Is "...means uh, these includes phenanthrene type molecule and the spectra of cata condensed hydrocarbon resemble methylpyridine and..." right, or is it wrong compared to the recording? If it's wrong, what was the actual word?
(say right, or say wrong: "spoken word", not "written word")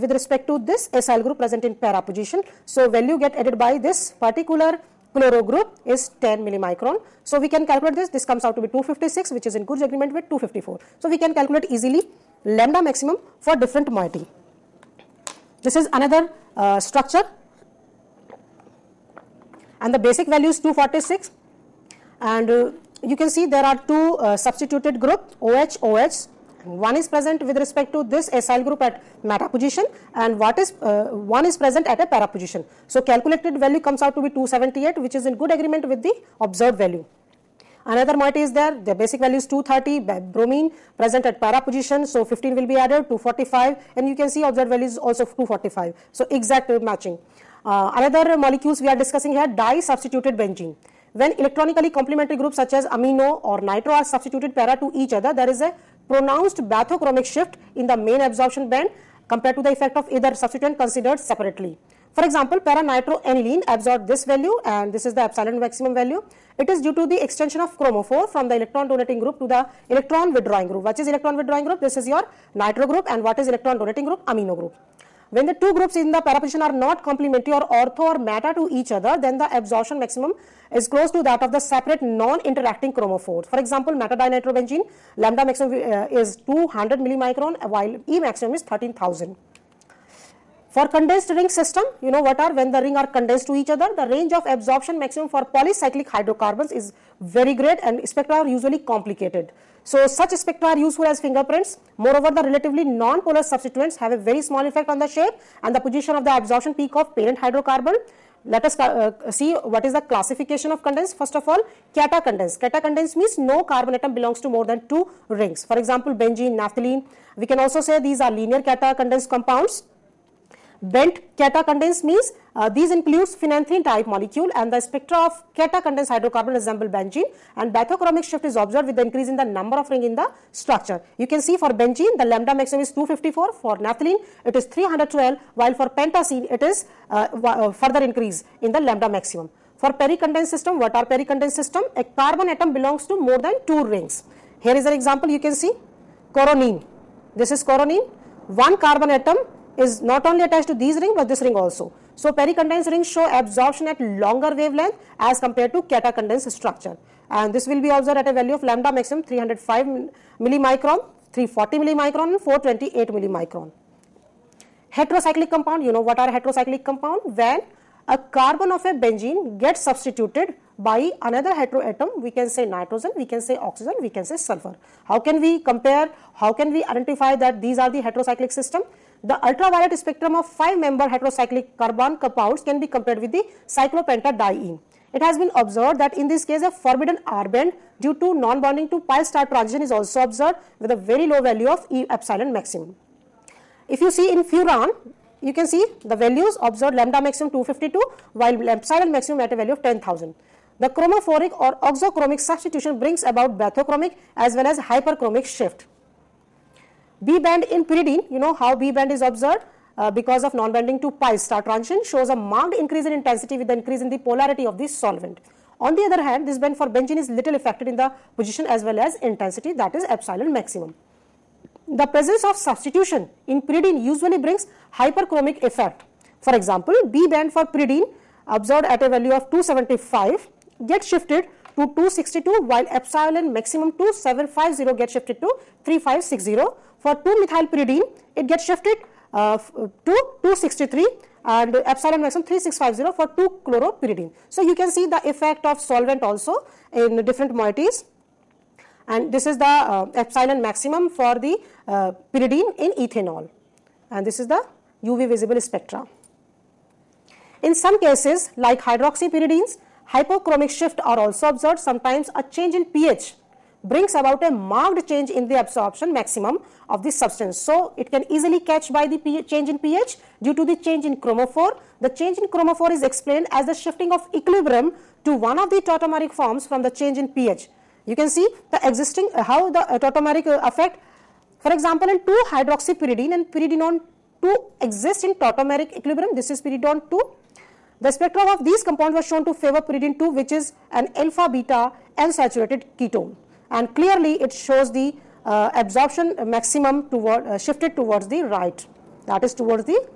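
wrong: "benzene", not "methylpyridine".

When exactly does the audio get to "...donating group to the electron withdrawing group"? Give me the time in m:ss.
1:08.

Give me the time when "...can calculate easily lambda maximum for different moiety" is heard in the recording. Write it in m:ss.
0:11.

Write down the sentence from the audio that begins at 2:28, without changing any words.
One carbon atom is not only attached to these ring but this ring also.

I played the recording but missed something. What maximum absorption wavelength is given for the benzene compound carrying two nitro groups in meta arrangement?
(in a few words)
200 millimicron.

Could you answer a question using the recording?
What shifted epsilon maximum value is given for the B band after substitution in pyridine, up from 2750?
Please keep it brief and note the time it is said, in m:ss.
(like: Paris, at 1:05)
3560, at 3:55.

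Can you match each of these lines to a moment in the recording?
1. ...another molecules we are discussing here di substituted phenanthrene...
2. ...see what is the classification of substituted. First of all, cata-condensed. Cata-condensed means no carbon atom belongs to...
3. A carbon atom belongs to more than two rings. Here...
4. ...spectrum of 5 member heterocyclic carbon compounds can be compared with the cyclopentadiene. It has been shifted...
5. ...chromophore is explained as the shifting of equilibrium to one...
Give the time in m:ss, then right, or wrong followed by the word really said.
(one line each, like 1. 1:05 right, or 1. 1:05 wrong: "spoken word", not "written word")
1. 0:47 wrong: "benzene", not "phenanthrene"
2. 1:49 wrong: "condensed", not "substituted"
3. 2:21 right
4. 2:59 wrong: "observed", not "shifted"
5. 4:32 right.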